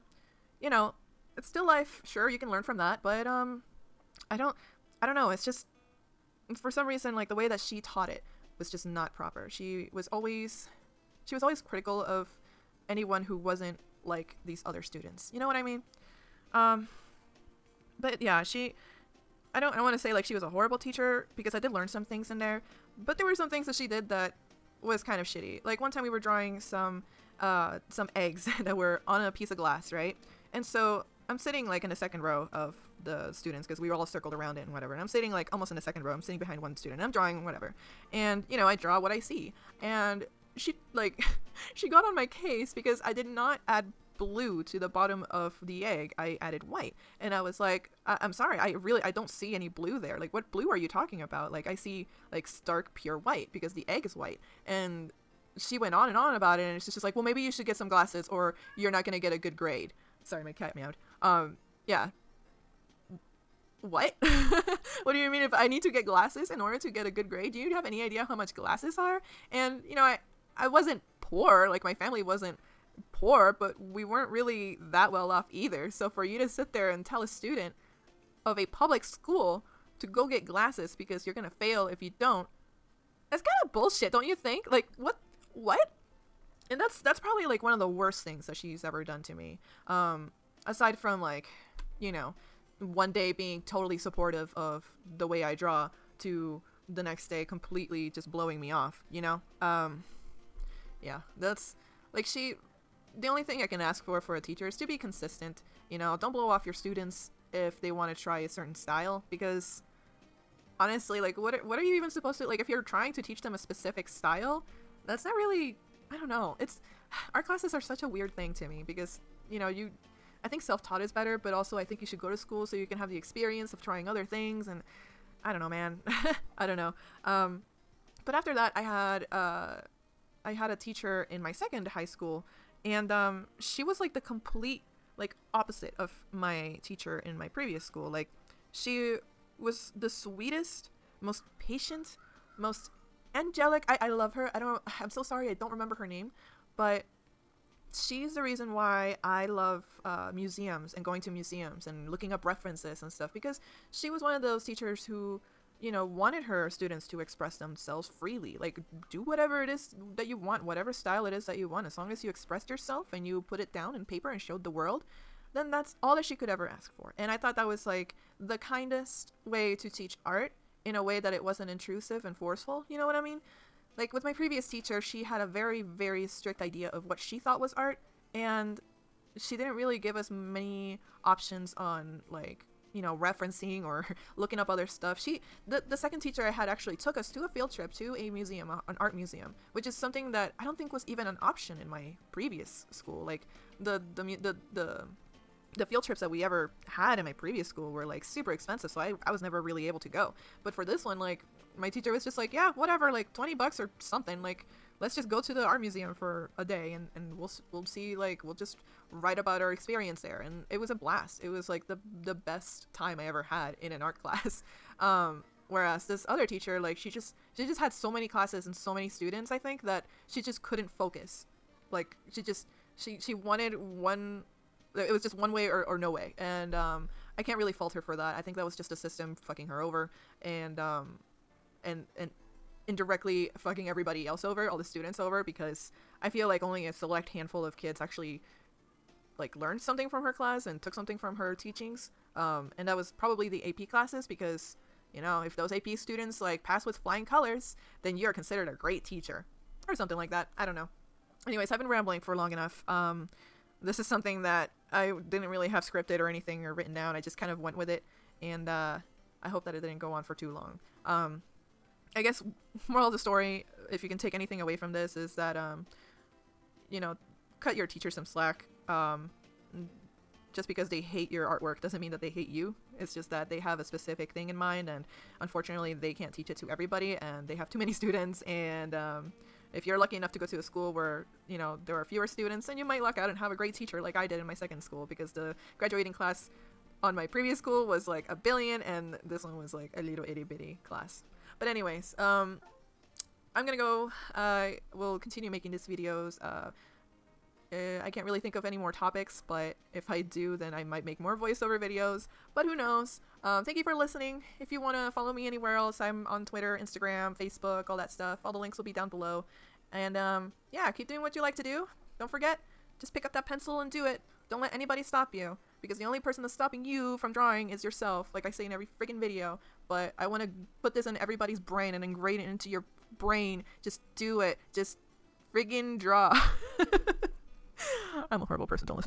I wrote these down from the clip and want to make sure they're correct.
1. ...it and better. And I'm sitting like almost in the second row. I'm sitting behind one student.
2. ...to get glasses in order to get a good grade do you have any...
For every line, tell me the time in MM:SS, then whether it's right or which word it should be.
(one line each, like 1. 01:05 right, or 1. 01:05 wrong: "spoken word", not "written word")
1. 00:34 wrong: "whatever", not "better"
2. 01:05 right.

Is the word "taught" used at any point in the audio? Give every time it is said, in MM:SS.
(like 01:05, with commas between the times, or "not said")
00:07, 02:00.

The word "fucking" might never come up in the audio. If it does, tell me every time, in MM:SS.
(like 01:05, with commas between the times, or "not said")
03:49, 03:53.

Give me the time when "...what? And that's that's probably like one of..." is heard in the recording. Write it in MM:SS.
01:25.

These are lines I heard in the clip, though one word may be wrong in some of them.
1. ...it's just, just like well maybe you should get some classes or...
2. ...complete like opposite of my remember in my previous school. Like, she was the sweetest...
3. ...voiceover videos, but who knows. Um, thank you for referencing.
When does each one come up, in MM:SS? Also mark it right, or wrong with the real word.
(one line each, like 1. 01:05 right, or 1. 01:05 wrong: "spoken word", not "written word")
1. 00:56 wrong: "glasses", not "classes"
2. 02:14 wrong: "teacher", not "remember"
3. 05:01 wrong: "listening", not "referencing".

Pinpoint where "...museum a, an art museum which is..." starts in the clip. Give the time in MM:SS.
03:08.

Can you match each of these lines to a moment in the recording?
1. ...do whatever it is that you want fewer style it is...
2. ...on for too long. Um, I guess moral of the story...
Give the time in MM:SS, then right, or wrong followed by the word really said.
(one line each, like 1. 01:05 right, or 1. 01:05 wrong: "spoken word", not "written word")
1. 02:39 wrong: "whatever", not "fewer"
2. 04:20 right.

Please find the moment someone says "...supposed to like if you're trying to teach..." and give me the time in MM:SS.
01:52.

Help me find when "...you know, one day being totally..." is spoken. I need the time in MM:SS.
01:31.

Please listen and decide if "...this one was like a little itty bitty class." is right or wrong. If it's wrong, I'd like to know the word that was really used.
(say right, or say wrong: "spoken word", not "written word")
right.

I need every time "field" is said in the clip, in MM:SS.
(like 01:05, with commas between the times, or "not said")
03:07, 03:15.